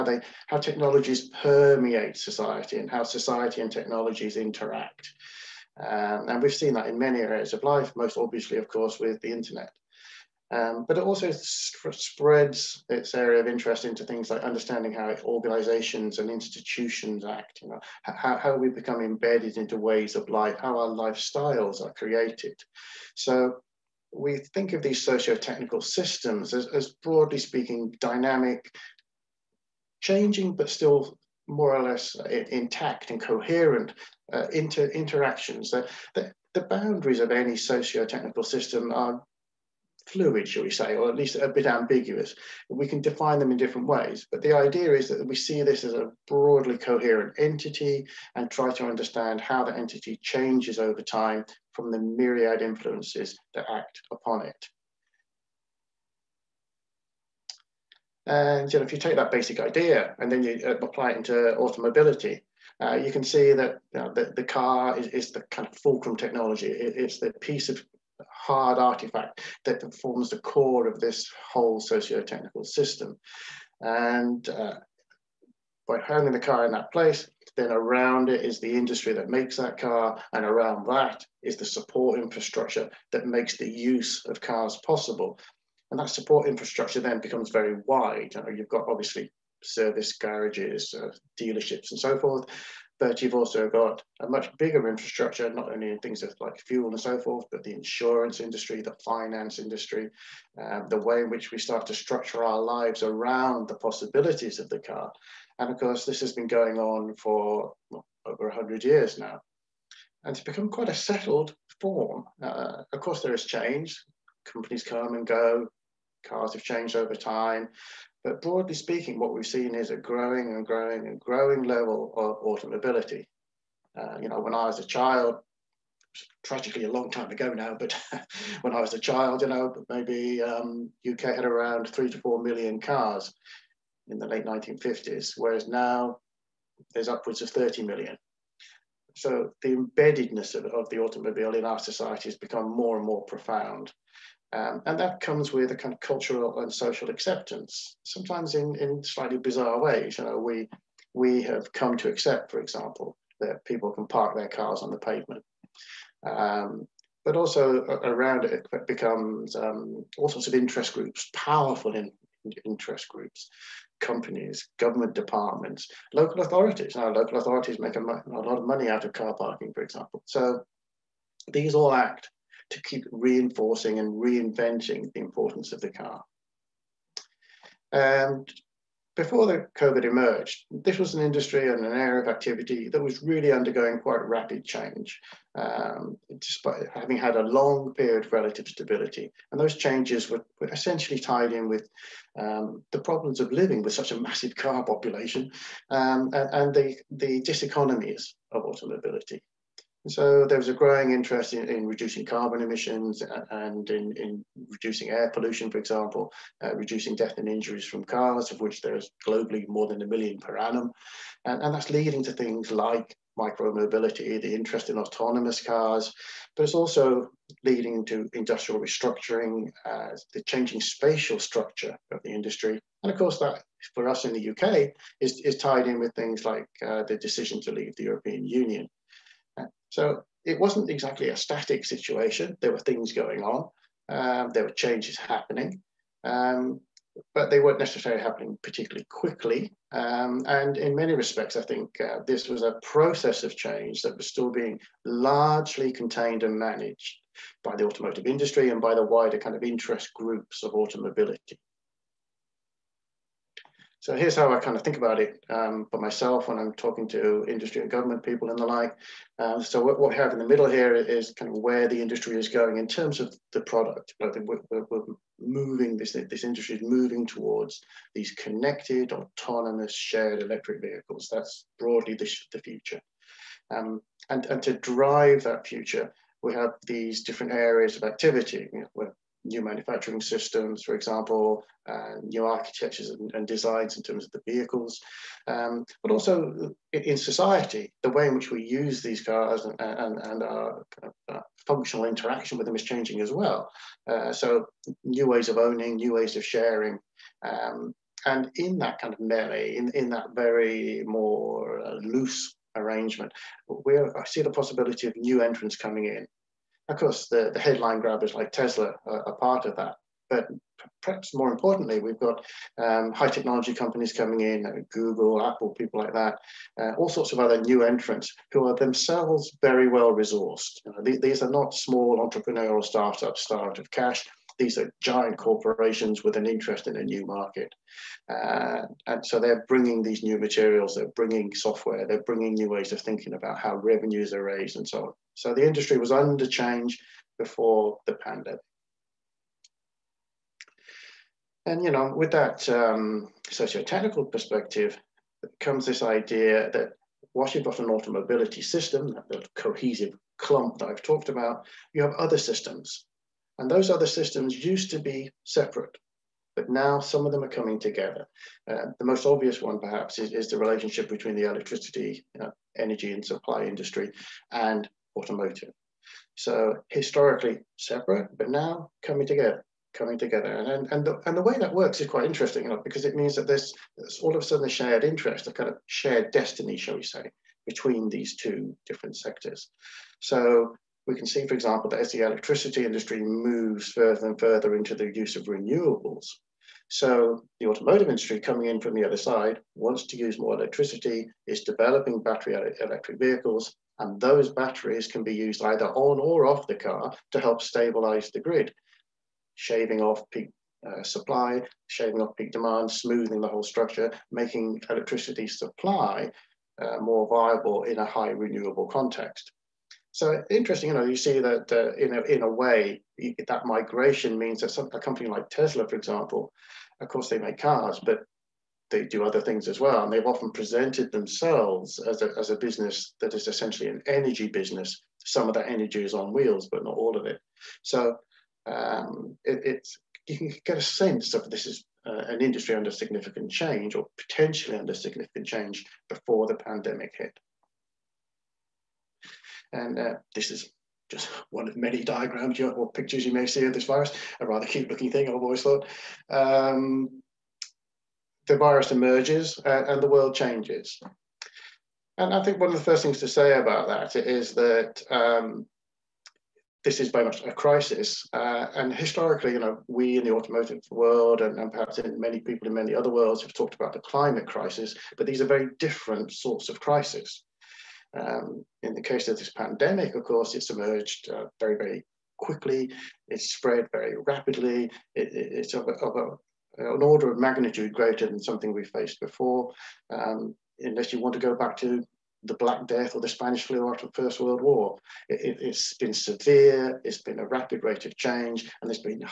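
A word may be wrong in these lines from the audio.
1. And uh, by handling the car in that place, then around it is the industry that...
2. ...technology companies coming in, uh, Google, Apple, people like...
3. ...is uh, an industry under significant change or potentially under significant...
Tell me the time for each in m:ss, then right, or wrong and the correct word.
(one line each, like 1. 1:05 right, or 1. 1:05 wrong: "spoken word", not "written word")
1. 1:13 right
2. 5:13 right
3. 7:11 right.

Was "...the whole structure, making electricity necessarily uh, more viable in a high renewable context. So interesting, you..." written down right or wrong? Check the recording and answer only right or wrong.
wrong.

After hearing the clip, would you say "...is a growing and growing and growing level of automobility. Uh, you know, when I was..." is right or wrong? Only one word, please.
right.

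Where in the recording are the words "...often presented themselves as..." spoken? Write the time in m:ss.
7:00.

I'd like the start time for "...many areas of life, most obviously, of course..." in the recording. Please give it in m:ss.
0:06.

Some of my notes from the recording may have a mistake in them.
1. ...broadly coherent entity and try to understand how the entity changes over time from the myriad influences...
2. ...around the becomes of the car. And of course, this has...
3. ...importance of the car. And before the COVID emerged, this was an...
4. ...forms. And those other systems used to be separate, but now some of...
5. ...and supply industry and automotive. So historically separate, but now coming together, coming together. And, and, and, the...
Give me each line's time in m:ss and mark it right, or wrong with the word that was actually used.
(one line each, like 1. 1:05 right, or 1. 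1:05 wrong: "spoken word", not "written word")
1. 0:46 right
2. 1:43 wrong: "possibilities", not "becomes"
3. 2:55 right
4. 5:52 wrong: "systems", not "forms"
5. 6:03 right.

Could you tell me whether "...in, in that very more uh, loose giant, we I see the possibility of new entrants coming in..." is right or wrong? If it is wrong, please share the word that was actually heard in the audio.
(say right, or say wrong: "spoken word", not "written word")
wrong: "arrangement", not "giant".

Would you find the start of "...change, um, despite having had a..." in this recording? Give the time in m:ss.
3:04.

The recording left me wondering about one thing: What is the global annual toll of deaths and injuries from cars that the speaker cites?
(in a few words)
more than a million.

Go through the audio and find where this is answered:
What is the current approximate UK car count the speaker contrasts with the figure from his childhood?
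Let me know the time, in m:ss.
2:17.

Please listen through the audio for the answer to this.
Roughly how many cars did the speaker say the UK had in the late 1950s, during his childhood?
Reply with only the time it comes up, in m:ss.
2:11.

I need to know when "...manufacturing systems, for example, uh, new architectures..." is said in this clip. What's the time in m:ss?
4:39.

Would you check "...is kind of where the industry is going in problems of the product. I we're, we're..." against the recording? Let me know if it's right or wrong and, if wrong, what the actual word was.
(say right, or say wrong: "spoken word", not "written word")
wrong: "terms", not "problems".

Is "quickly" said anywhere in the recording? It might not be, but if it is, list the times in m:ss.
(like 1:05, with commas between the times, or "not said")
3:59, 7:52.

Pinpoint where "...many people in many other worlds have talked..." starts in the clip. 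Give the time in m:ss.
7:42.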